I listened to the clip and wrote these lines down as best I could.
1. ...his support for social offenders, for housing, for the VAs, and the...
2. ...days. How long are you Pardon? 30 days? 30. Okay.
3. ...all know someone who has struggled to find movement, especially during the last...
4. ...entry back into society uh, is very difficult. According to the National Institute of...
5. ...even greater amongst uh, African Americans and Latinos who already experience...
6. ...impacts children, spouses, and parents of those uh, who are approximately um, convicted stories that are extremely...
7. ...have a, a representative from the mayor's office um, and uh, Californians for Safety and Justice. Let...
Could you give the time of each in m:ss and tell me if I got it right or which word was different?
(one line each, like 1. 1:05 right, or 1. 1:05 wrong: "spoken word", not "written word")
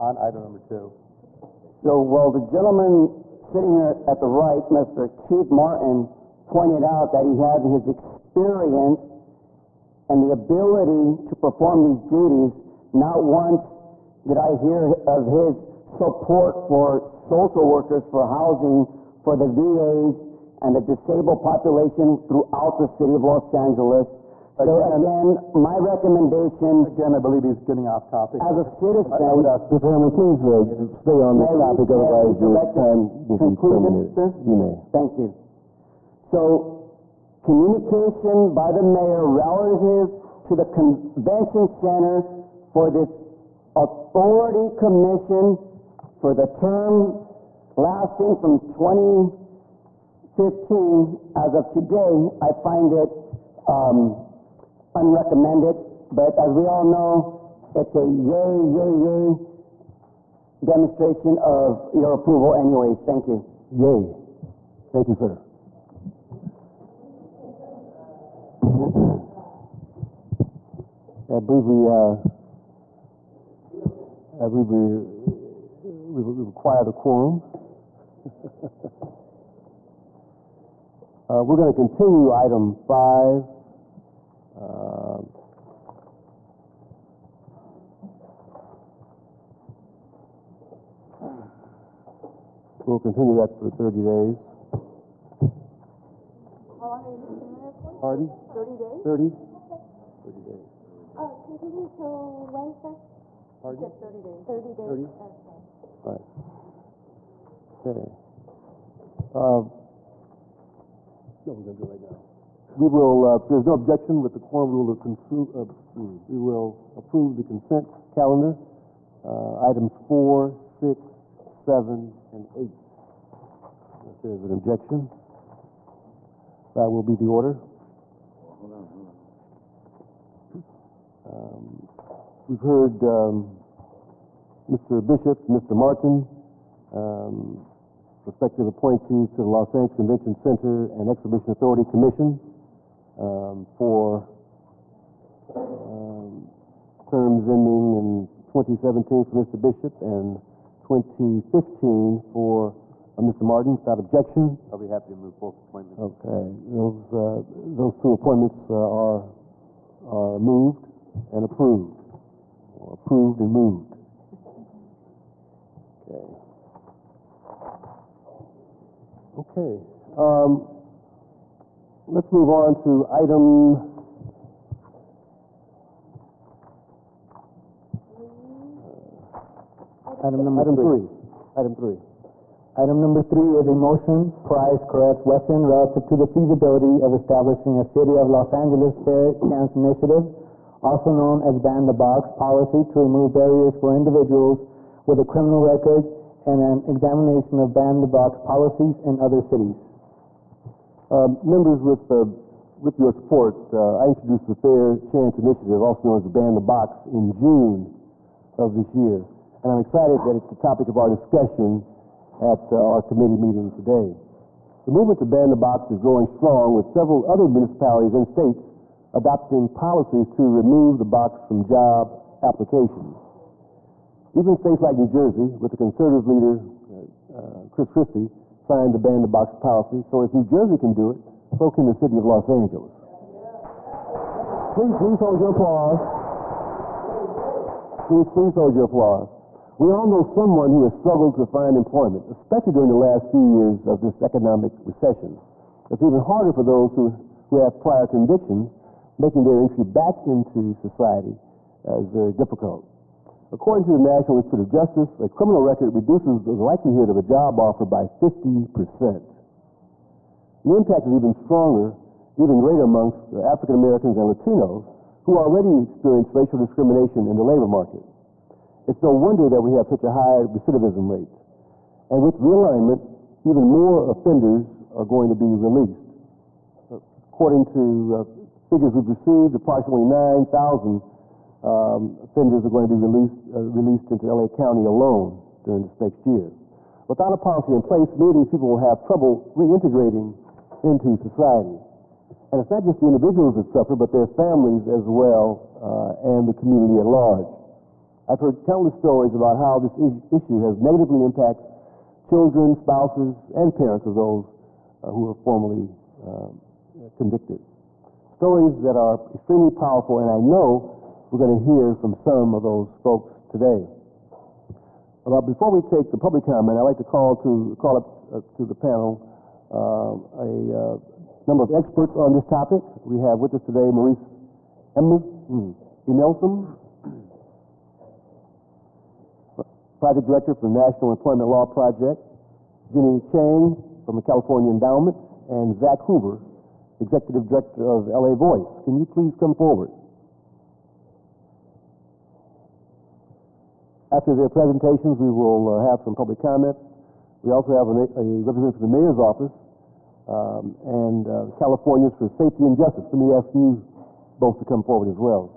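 1. 0:15 wrong: "workers", not "offenders"
2. 1:34 right
3. 3:59 wrong: "employment", not "movement"
4. 4:09 right
5. 4:22 right
6. 5:01 wrong: "formally", not "approximately"
7. 5:47 right.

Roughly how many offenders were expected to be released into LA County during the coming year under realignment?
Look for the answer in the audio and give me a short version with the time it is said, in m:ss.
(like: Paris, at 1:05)
9,000, at 4:40.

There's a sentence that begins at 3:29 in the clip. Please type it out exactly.
And I'm excited that it's the topic of our discussion at uh, our committee meeting today.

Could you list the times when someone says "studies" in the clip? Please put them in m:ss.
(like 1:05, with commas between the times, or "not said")
not said.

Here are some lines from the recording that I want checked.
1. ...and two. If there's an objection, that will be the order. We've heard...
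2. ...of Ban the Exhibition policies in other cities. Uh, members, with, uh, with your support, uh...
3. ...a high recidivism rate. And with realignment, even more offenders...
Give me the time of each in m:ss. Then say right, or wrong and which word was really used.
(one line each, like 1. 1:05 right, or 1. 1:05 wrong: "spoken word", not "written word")
1. 2:02 wrong: "eight", not "two"
2. 3:17 wrong: "Box", not "Exhibition"
3. 4:30 right.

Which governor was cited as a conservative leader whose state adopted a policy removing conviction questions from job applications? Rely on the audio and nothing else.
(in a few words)
Chris Christie.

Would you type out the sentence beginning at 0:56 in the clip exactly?
But as we all know, it's a yay, yay, yay demonstration of your approval anyways.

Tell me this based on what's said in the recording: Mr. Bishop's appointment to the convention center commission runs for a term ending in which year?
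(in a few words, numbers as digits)
2017.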